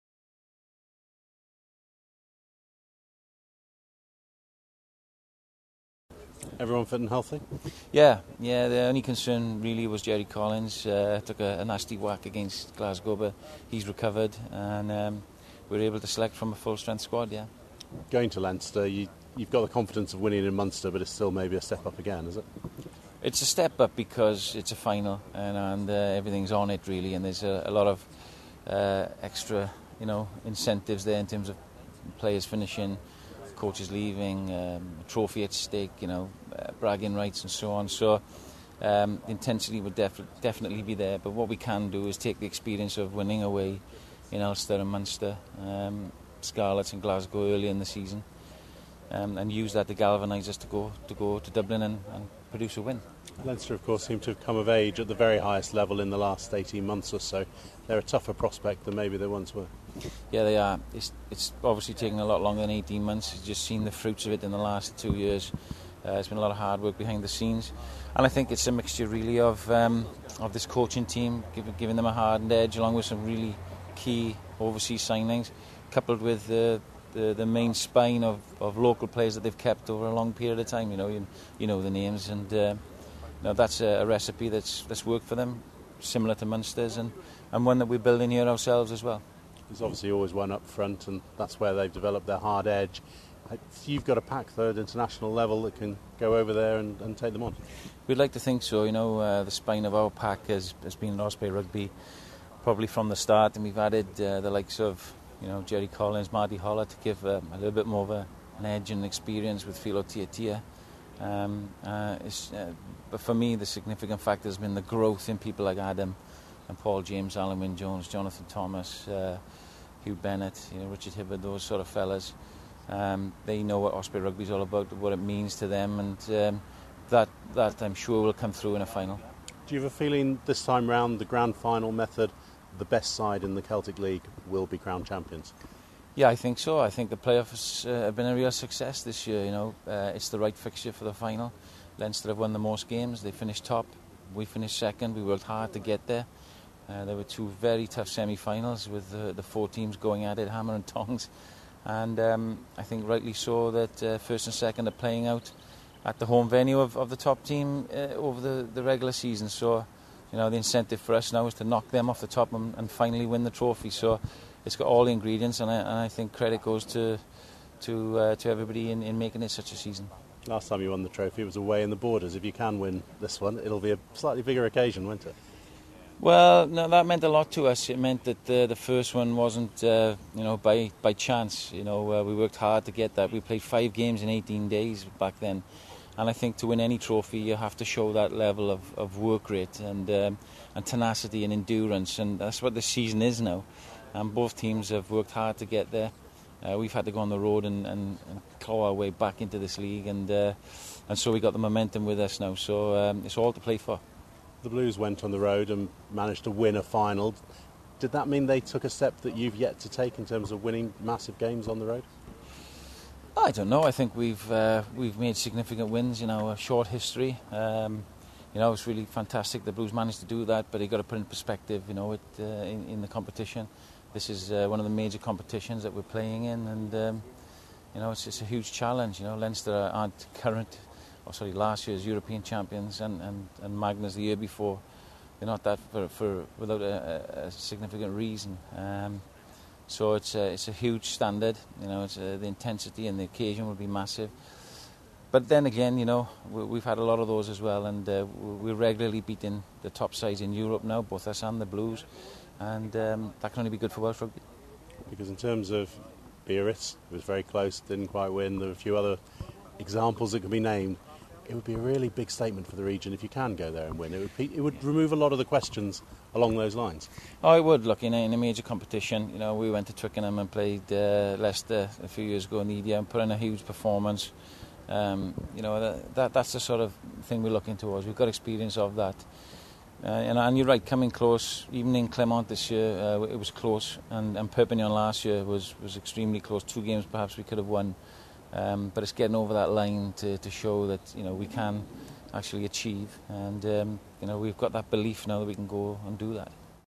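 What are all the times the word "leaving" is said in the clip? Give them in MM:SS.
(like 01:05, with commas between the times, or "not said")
00:33.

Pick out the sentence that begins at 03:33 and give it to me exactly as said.
I think we've uh, we've made significant wins in our short history.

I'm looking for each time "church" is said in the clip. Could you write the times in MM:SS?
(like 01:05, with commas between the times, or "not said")
not said.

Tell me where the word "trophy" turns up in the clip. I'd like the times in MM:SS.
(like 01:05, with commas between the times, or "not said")
00:35, 02:43, 02:51, 03:06.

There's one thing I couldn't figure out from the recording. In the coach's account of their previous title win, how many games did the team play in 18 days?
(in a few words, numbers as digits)
5.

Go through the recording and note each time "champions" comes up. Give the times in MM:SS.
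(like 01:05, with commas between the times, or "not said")
02:15, 03:52.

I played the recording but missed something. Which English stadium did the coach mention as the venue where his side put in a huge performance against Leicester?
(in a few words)
Twickenham.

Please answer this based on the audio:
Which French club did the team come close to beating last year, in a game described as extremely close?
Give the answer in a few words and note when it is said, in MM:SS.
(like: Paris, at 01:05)
Perpignan, at 04:44.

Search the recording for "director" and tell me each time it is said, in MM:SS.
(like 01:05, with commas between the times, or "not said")
not said.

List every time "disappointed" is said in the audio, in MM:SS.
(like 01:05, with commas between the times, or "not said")
not said.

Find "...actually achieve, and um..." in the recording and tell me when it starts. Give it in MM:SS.
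04:52.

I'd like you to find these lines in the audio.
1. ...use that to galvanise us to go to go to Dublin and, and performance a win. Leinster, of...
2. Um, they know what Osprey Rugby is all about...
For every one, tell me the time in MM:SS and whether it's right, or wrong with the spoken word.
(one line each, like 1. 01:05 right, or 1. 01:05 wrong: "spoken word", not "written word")
1. 00:49 wrong: "produce", not "performance"
2. 02:02 right.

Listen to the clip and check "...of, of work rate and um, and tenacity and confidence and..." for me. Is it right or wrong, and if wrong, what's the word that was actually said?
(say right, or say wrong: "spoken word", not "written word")
wrong: "endurance", not "confidence".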